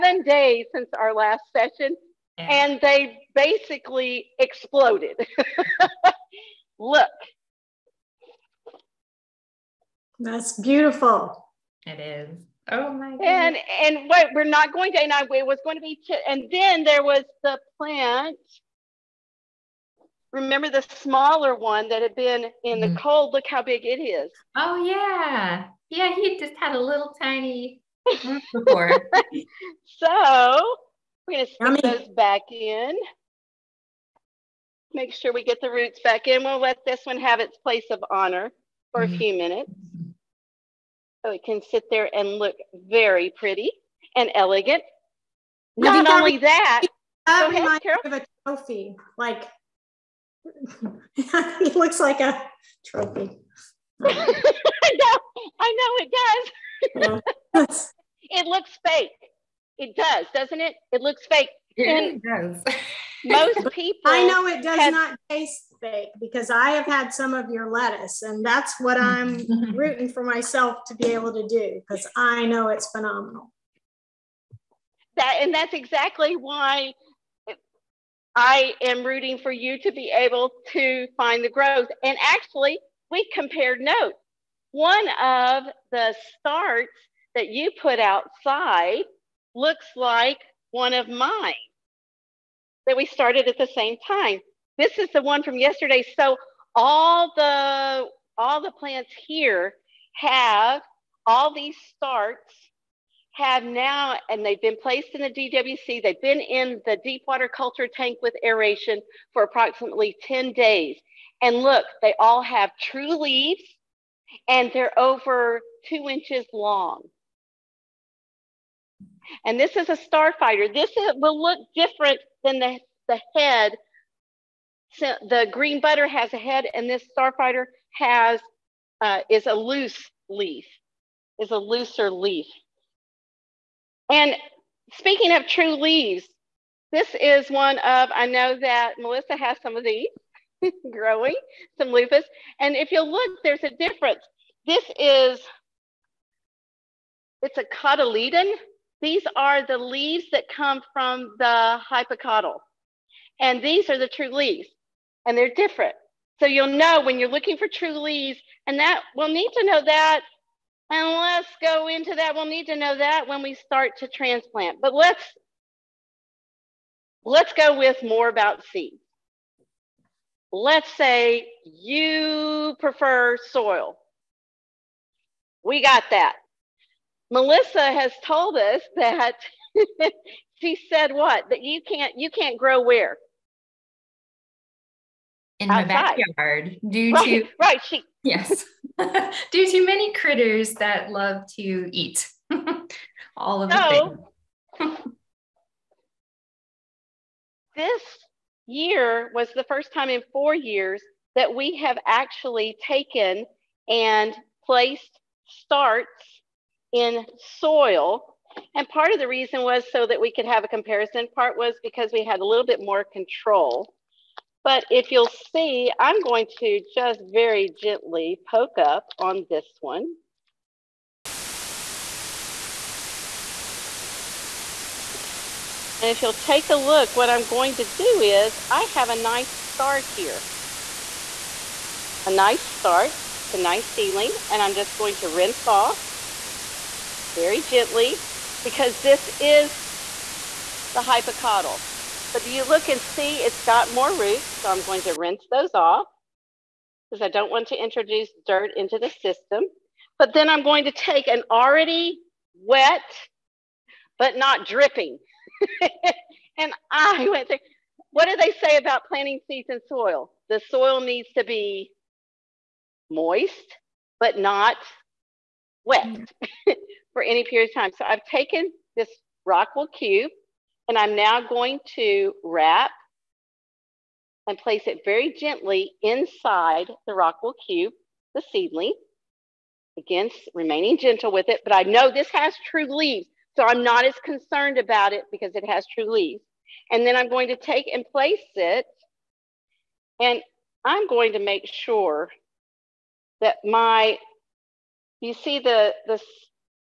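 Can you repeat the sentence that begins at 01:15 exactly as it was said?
That and that's exactly why I am rooting for you to be able to find the growth.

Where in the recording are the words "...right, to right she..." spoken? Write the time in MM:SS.
03:07.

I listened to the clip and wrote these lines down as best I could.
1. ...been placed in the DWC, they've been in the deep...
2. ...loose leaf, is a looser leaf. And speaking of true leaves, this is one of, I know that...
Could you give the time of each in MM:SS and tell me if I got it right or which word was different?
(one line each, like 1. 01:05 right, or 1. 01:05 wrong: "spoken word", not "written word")
1. 01:44 right
2. 02:09 right.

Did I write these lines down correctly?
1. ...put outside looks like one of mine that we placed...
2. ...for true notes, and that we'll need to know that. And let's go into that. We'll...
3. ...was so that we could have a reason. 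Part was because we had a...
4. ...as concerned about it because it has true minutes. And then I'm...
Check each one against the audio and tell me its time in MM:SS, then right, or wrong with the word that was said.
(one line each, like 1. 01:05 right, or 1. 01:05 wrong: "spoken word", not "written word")
1. 01:27 wrong: "started", not "placed"
2. 02:37 wrong: "leaves", not "notes"
3. 03:29 wrong: "comparison", not "reason"
4. 04:44 wrong: "leaves", not "minutes".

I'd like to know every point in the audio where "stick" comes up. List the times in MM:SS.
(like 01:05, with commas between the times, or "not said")
00:31.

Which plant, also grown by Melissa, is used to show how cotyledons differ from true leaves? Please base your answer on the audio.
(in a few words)
Loofah.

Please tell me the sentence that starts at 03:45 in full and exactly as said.
And if you'll take a look, what I'm going to do is I have a nice start here.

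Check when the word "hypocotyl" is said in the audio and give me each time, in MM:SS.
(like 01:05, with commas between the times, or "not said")
02:31, 04:01.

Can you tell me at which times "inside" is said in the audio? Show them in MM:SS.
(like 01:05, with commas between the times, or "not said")
04:36.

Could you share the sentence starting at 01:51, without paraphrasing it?
And look, they all have true leaves and they're over two inches long.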